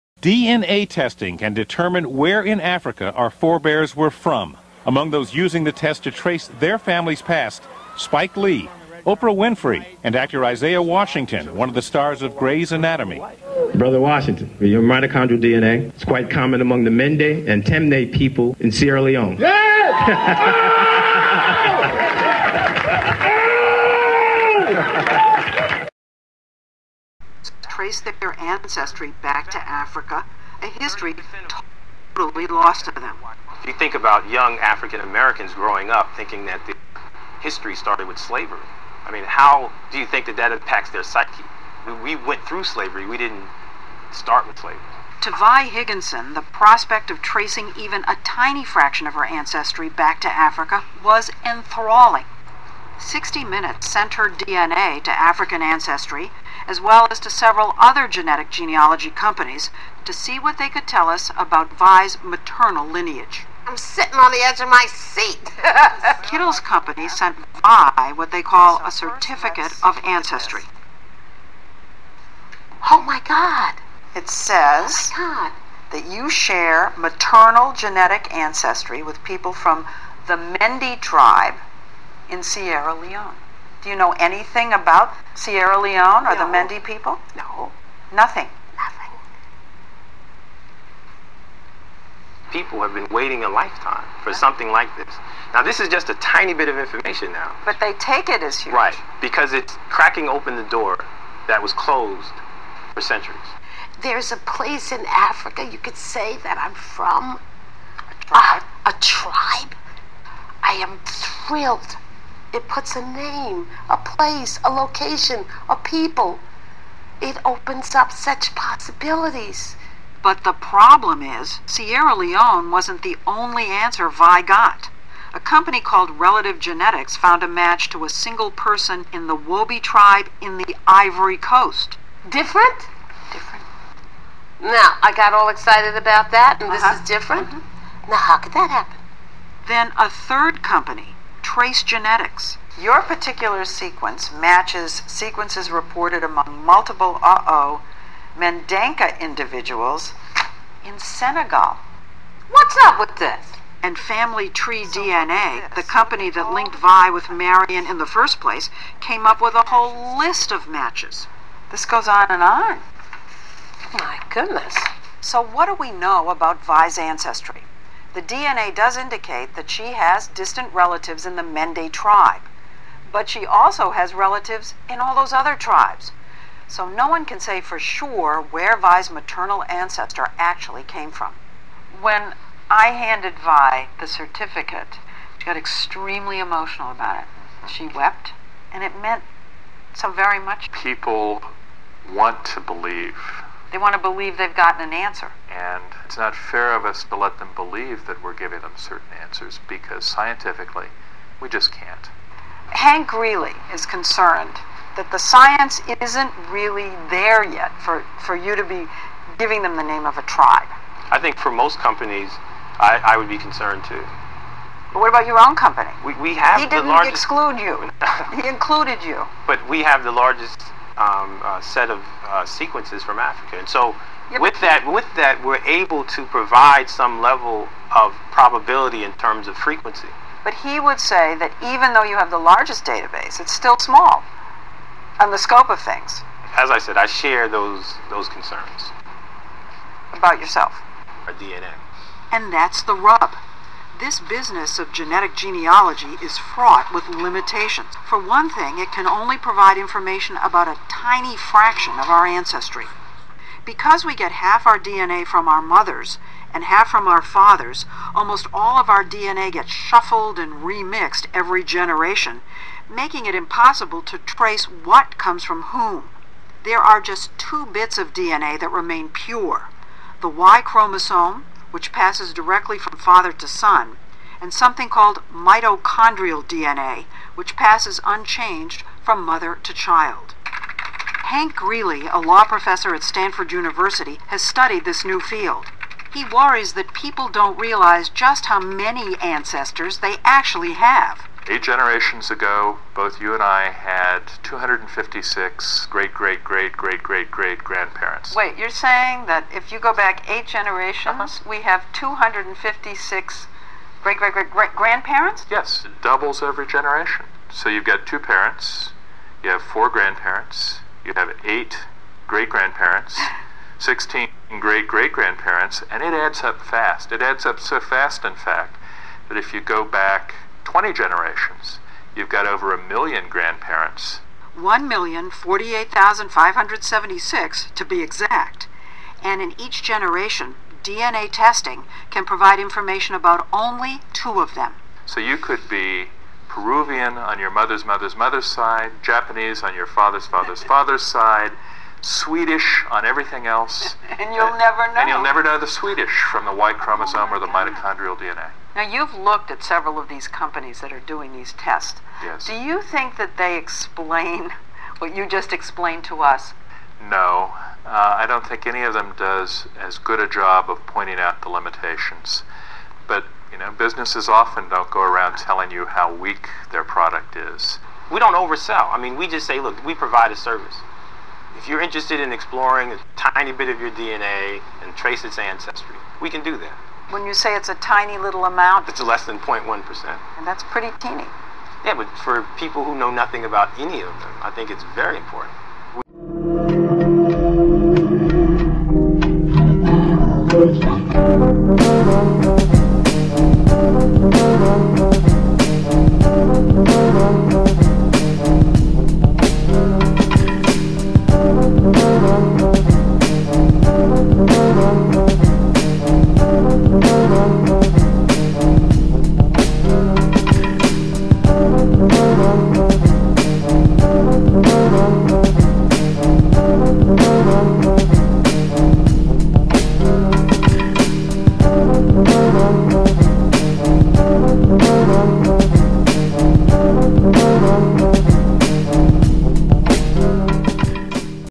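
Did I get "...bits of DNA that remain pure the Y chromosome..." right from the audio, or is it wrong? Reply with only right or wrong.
right.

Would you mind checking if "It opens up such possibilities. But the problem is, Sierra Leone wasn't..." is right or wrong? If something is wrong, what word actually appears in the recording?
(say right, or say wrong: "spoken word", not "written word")
right.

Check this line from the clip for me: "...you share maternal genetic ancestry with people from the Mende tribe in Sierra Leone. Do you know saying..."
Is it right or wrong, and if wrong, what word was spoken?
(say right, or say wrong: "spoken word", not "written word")
wrong: "anything", not "saying".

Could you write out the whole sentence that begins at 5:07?
So you've got two parents, you have four grandparents, you have eight great grandparents.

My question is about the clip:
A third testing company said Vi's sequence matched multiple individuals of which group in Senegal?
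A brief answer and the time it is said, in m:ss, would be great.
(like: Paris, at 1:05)
Mandinka, at 2:28.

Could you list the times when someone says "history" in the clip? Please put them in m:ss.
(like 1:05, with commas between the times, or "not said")
0:30, 0:37.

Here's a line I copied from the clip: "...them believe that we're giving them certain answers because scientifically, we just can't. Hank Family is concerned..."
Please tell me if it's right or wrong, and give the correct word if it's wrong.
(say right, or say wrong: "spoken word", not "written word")
wrong: "Greeley", not "Family".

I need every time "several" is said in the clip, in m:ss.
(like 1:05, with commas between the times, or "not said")
0:57, 5:49.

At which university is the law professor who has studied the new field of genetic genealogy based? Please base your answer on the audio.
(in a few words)
Stanford University.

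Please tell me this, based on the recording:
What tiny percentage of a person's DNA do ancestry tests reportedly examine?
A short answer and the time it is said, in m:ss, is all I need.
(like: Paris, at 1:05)
less than 0.1%, at 6:19.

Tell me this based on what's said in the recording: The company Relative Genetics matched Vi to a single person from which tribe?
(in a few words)
Wobi.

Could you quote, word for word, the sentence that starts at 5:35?
So you could be Peruvian on your mother's mother's mother's side, Japanese on your father's father's father's side, Swedish on everything else.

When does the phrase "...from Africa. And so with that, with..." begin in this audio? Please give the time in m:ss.
3:43.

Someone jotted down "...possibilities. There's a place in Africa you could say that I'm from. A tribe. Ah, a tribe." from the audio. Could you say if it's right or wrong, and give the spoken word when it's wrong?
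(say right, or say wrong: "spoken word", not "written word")
wrong: "centuries", not "possibilities".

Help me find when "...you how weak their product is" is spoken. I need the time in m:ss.
6:05.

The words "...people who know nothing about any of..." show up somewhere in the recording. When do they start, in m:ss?
6:22.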